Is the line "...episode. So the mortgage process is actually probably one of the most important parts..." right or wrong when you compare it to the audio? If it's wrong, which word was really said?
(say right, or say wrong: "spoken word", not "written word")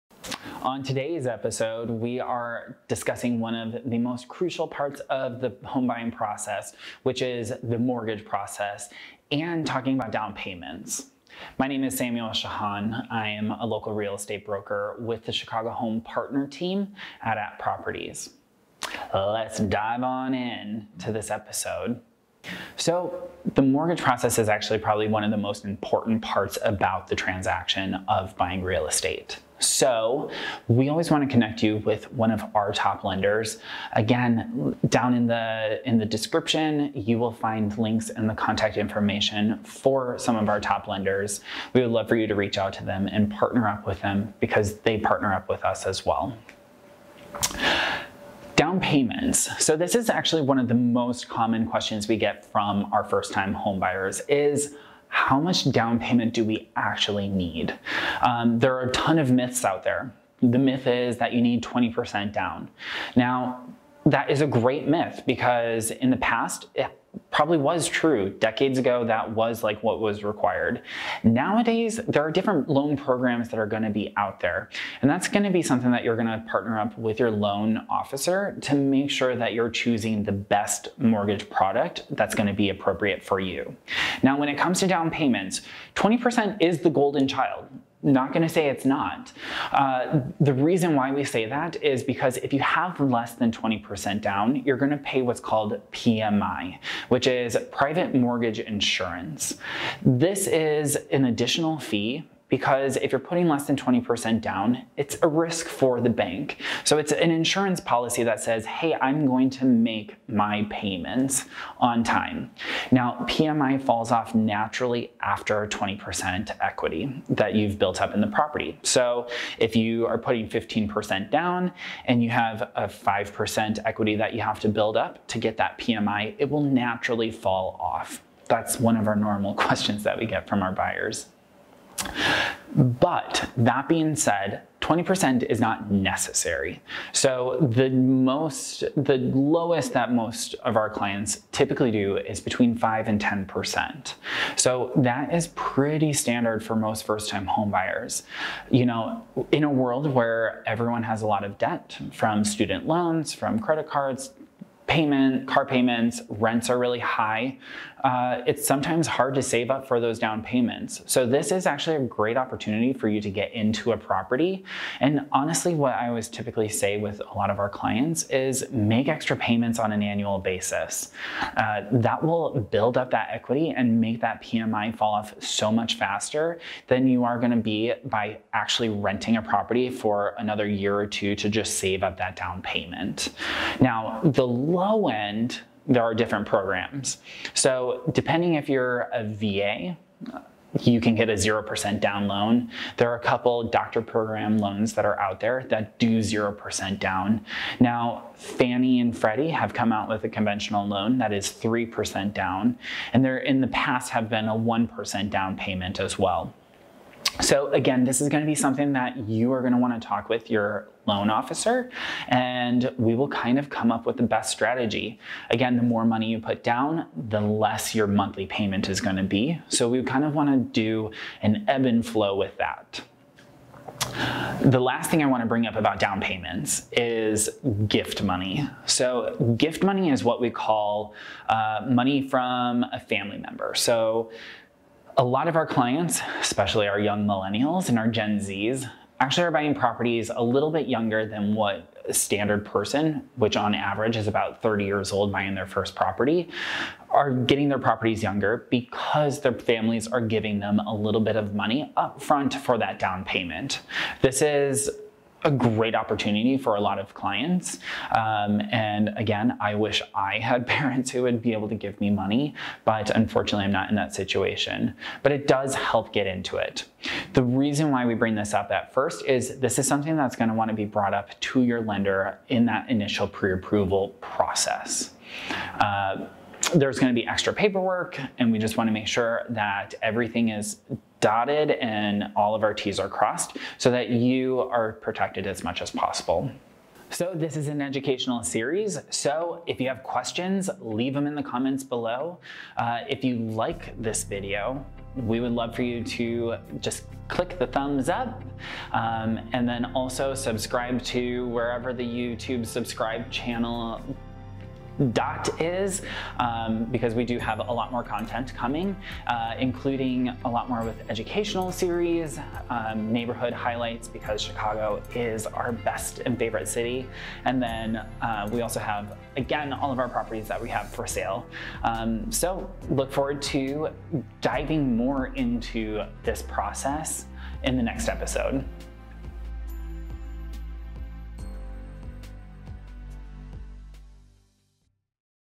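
right.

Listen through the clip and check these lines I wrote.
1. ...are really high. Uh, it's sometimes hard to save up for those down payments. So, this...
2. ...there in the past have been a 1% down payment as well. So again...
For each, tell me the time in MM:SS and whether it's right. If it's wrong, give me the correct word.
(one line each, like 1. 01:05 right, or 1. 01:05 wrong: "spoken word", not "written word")
1. 02:36 right
2. 03:23 right.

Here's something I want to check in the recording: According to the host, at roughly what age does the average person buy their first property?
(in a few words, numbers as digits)
30.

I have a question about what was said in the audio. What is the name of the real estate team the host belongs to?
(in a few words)
Chicago Home Partner Team.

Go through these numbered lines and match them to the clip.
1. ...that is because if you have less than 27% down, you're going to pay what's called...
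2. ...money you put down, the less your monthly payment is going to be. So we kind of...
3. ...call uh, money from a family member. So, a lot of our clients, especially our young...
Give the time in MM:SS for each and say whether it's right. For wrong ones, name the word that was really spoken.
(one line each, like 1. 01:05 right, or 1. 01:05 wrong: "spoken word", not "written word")
1. 01:31 wrong: "20", not "27"
2. 03:36 right
3. 03:50 right.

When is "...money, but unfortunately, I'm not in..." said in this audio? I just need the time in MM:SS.
04:22.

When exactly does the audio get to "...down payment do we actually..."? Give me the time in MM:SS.
00:55.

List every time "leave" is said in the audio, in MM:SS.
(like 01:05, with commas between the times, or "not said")
04:50.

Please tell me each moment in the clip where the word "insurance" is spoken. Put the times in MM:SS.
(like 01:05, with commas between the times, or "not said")
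01:38, 01:47.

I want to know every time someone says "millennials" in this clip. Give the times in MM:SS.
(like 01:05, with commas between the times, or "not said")
03:57.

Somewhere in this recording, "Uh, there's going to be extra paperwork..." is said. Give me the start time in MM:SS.
04:35.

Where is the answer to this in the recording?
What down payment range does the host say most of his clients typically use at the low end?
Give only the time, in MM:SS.
02:22.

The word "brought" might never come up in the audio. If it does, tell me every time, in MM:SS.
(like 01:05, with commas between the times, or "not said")
04:30.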